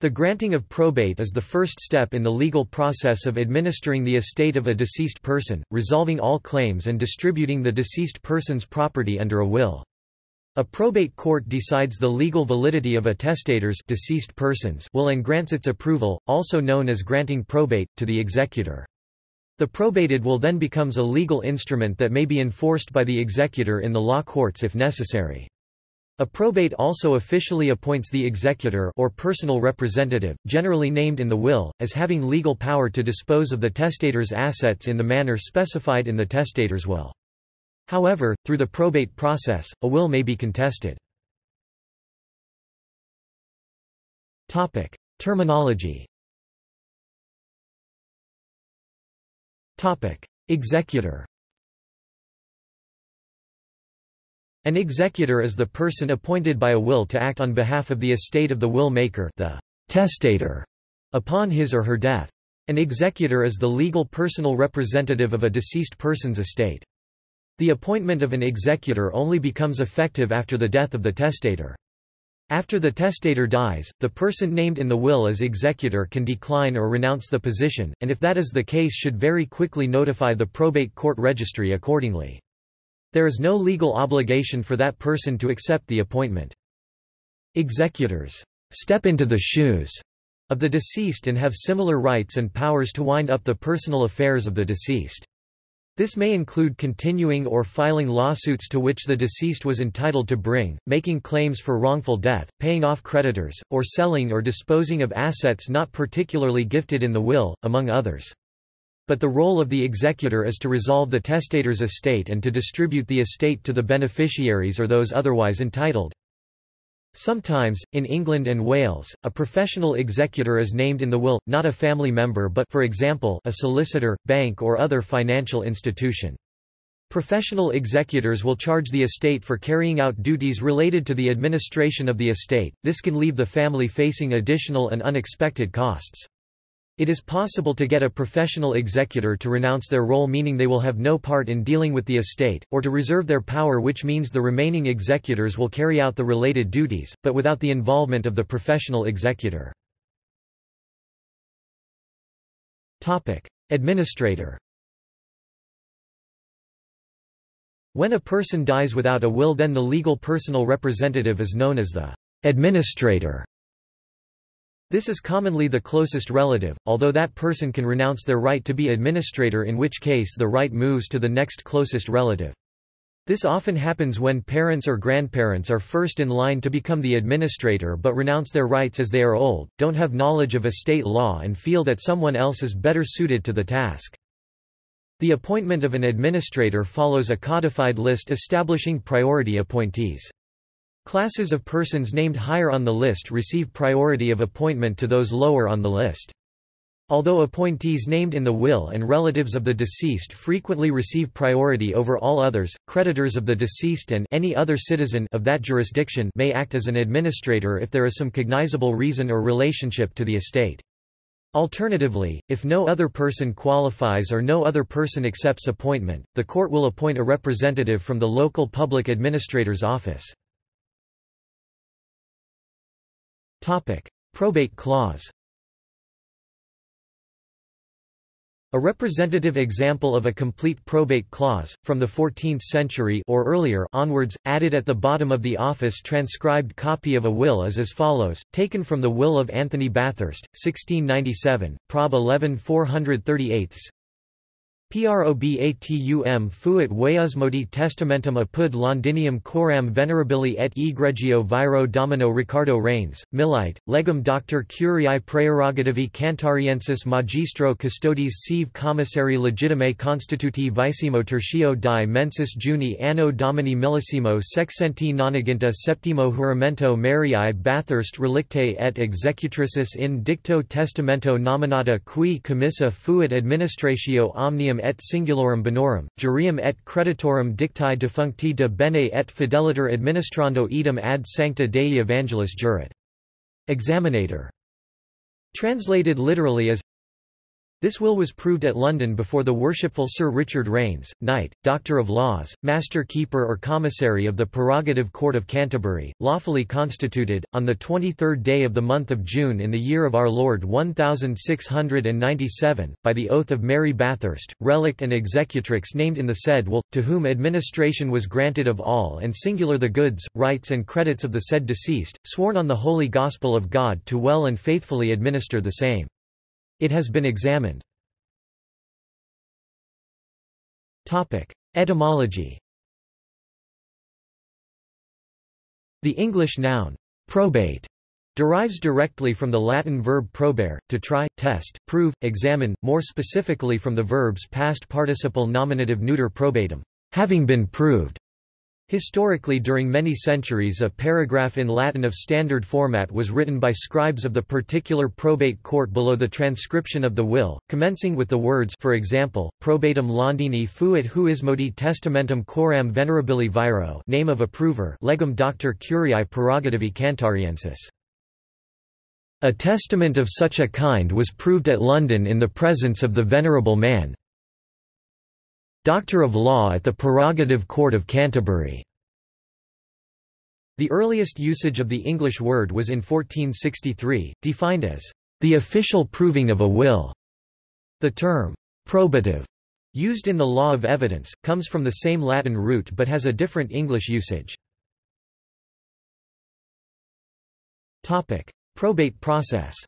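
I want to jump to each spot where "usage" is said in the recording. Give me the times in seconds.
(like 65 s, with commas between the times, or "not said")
371 s, 384 s.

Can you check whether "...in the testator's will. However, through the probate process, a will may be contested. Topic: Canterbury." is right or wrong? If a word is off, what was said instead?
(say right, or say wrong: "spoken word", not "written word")
wrong: "Terminology", not "Canterbury".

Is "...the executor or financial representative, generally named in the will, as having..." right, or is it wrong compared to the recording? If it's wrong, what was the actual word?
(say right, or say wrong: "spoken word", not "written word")
wrong: "personal", not "financial".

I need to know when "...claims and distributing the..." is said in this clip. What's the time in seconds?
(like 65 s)
6 s.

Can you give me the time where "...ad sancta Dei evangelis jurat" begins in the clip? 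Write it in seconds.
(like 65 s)
281 s.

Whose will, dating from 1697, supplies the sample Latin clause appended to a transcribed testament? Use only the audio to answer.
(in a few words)
Anthony Bathurst.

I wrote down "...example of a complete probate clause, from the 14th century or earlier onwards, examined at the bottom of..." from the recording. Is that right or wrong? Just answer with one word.
wrong.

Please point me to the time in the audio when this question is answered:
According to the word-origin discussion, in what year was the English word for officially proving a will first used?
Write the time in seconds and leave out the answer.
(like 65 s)
372 s.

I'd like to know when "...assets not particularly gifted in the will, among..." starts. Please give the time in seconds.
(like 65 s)
105 s.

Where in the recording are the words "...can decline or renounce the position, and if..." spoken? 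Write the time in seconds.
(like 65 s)
76 s.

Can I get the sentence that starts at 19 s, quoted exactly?
The probated will then becomes a legal instrument that may be enforced by the executor in the law courts if necessary.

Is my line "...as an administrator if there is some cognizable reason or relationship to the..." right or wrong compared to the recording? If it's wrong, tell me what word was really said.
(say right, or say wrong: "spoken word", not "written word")
right.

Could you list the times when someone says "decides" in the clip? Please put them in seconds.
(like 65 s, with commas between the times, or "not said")
11 s.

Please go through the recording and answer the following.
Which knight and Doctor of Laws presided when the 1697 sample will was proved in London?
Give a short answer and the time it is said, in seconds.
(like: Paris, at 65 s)
Sir Richard Raines, at 290 s.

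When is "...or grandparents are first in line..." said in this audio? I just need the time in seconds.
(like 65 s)
174 s.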